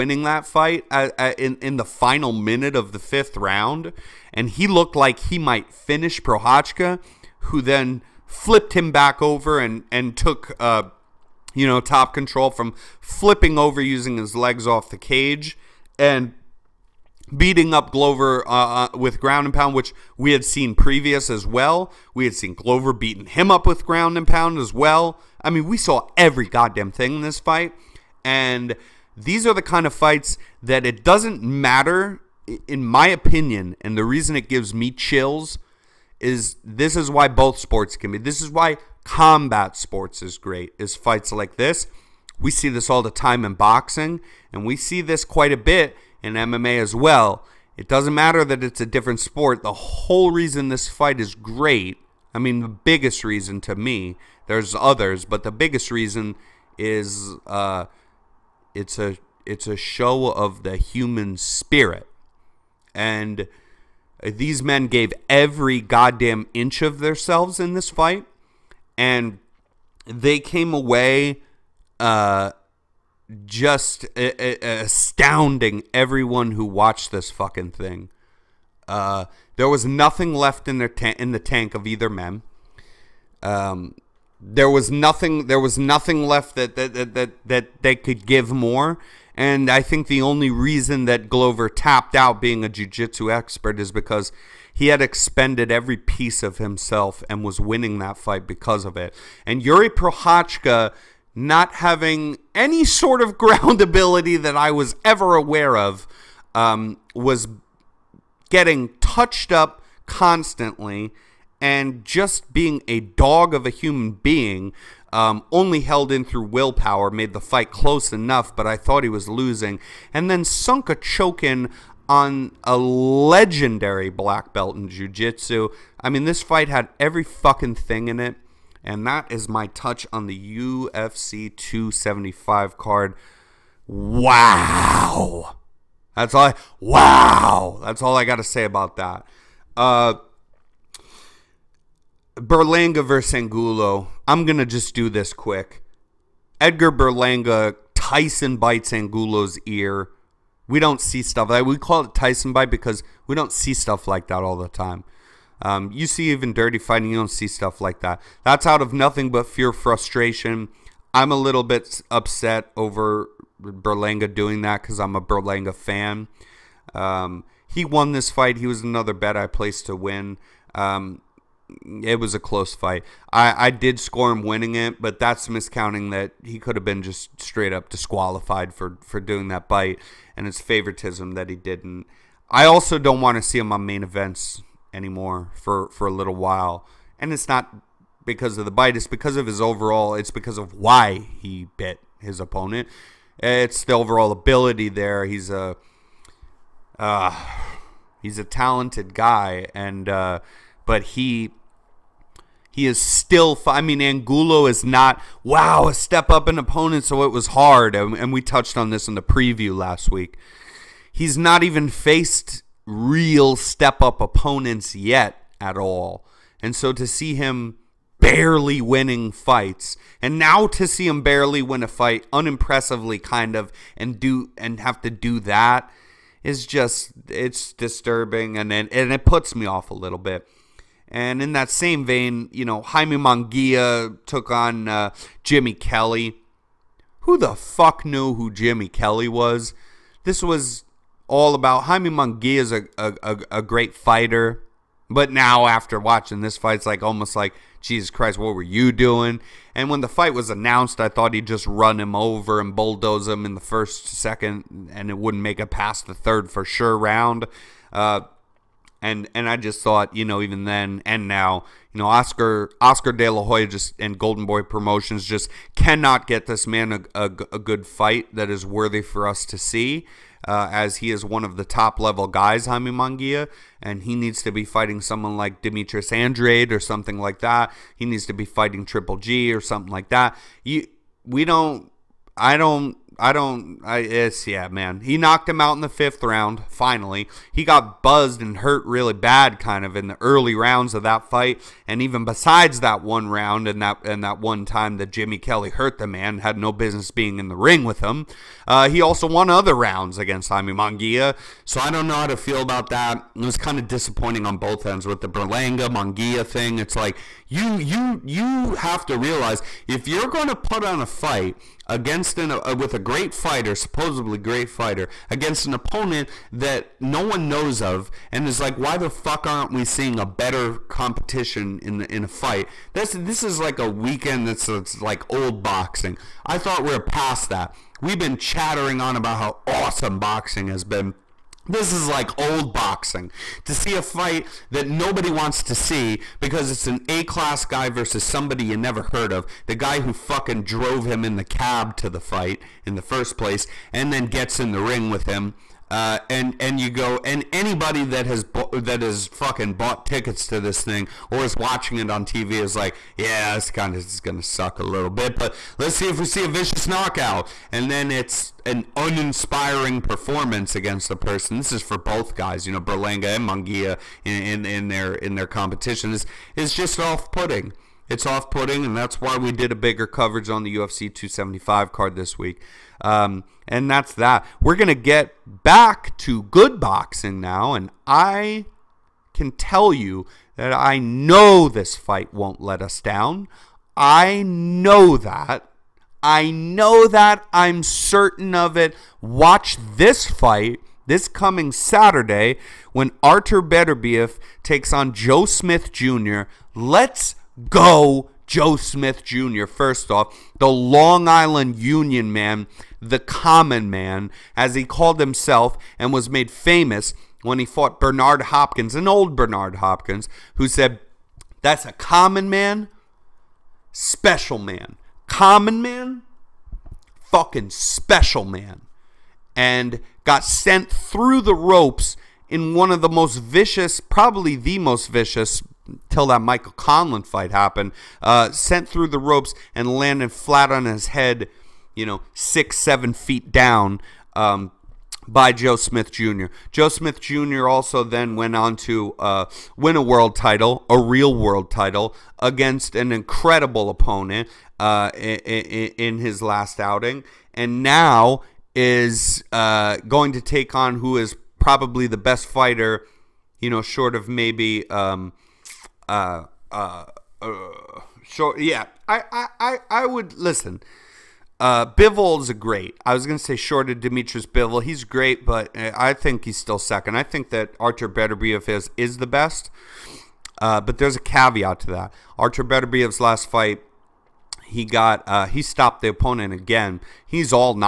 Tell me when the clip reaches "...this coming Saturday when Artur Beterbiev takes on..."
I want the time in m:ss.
6:31.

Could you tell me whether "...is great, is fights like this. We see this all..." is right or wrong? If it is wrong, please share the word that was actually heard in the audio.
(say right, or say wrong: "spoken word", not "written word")
right.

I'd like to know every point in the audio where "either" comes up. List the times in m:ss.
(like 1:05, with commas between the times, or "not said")
1:21.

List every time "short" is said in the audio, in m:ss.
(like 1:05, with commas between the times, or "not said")
7:33, 7:38, 7:43.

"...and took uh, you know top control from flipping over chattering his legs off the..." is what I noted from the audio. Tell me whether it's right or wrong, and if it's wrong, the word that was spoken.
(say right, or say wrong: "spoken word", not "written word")
wrong: "using", not "chattering".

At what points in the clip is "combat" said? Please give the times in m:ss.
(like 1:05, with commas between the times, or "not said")
0:39.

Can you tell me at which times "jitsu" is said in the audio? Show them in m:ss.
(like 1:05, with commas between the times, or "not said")
1:32, 2:05.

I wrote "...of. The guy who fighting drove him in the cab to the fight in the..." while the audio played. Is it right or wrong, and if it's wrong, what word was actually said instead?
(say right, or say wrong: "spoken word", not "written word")
wrong: "fucking", not "fighting".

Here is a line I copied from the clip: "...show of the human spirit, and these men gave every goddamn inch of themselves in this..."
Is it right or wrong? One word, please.
right.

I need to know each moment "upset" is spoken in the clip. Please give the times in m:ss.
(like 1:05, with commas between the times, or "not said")
2:42.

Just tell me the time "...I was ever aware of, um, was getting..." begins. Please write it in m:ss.
1:44.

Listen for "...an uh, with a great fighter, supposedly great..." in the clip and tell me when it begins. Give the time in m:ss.
5:12.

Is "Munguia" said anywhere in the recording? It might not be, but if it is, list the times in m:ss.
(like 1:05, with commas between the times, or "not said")
3:53, 4:02, 4:32, 5:00, 5:05, 6:03.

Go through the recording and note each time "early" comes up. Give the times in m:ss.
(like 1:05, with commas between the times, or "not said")
4:50.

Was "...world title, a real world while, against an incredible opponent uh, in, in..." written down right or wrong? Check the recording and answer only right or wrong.
wrong.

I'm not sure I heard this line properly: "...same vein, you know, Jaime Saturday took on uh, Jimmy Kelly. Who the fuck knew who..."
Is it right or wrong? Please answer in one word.
wrong.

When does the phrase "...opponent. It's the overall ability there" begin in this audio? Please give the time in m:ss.
3:12.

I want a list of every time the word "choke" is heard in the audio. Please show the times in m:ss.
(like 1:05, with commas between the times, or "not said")
2:00.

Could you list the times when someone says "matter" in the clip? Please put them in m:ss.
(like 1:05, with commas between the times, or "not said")
0:31, 0:48.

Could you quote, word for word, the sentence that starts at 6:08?
It's off putting, and that's why we did a bigger coverage on the UFC 275 card this week.